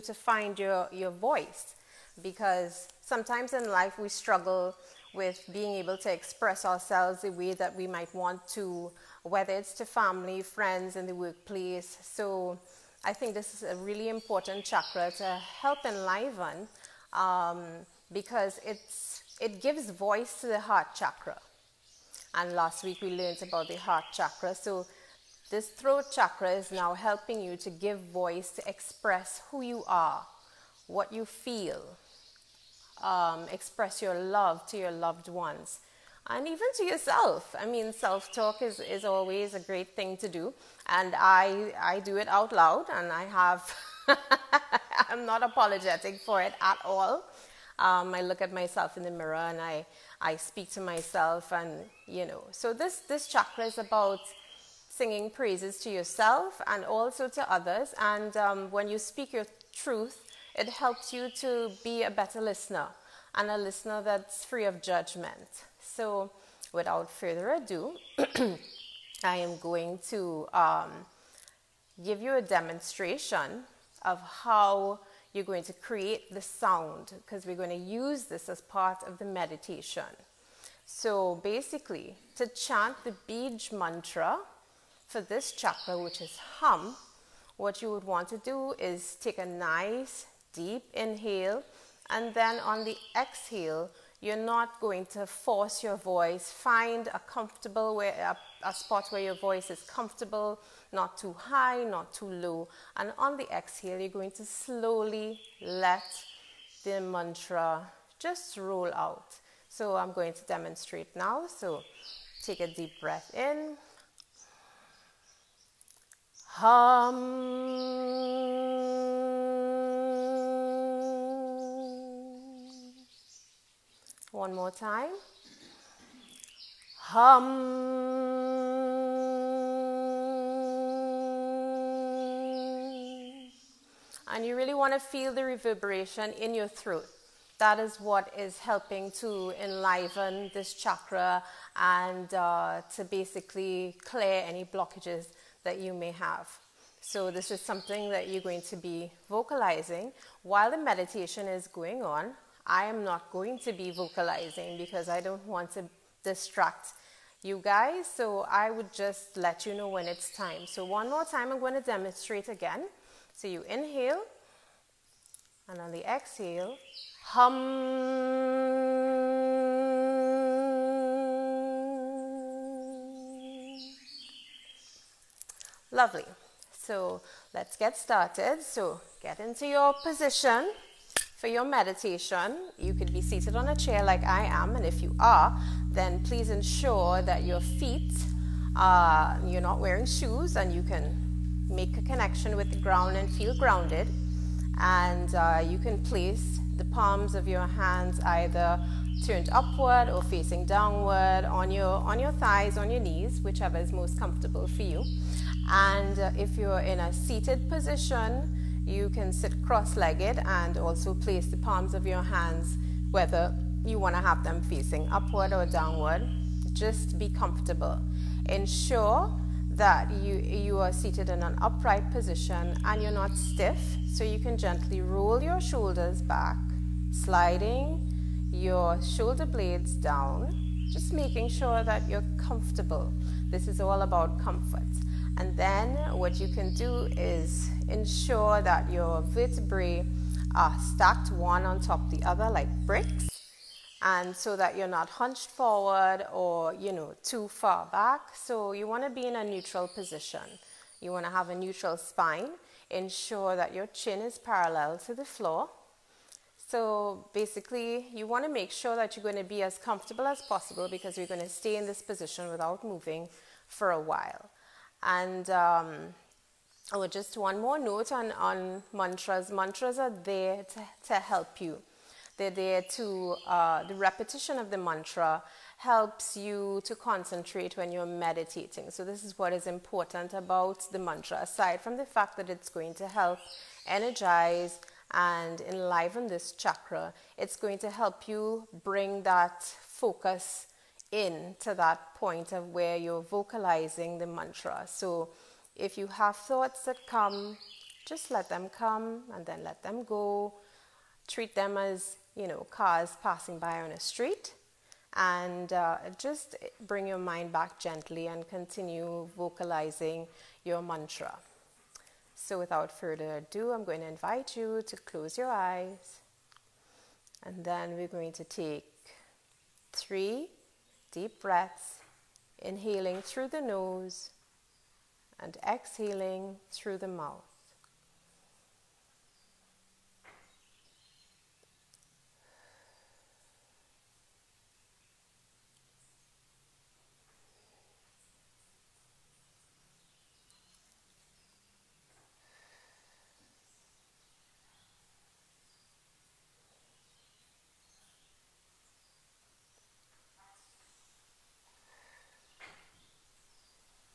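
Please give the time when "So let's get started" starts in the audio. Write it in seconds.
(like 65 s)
176 s.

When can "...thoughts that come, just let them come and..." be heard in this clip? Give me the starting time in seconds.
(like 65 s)
296 s.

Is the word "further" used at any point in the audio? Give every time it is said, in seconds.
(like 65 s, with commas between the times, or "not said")
67 s, 312 s.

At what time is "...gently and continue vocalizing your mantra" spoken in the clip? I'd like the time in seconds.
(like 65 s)
307 s.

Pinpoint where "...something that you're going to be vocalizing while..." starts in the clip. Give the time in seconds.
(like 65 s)
147 s.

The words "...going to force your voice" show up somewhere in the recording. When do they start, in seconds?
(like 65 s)
94 s.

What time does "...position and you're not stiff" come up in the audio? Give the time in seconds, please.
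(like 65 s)
222 s.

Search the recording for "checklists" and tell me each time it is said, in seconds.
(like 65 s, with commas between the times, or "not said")
not said.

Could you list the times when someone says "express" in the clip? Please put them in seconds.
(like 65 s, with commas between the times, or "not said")
6 s, 28 s, 33 s.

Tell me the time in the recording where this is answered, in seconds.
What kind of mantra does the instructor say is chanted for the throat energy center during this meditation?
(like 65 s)
83 s.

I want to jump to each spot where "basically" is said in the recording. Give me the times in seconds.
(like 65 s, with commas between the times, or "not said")
81 s, 143 s, 257 s.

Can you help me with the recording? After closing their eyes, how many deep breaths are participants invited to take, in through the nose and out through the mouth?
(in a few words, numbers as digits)
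3.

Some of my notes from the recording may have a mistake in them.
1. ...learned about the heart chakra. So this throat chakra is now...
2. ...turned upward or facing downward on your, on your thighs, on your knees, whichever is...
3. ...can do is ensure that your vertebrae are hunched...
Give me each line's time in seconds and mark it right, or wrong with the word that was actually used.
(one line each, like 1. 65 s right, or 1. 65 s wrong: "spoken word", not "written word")
1. 23 s right
2. 199 s right
3. 236 s wrong: "stacked", not "hunched".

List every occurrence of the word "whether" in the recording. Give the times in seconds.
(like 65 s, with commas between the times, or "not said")
9 s, 213 s.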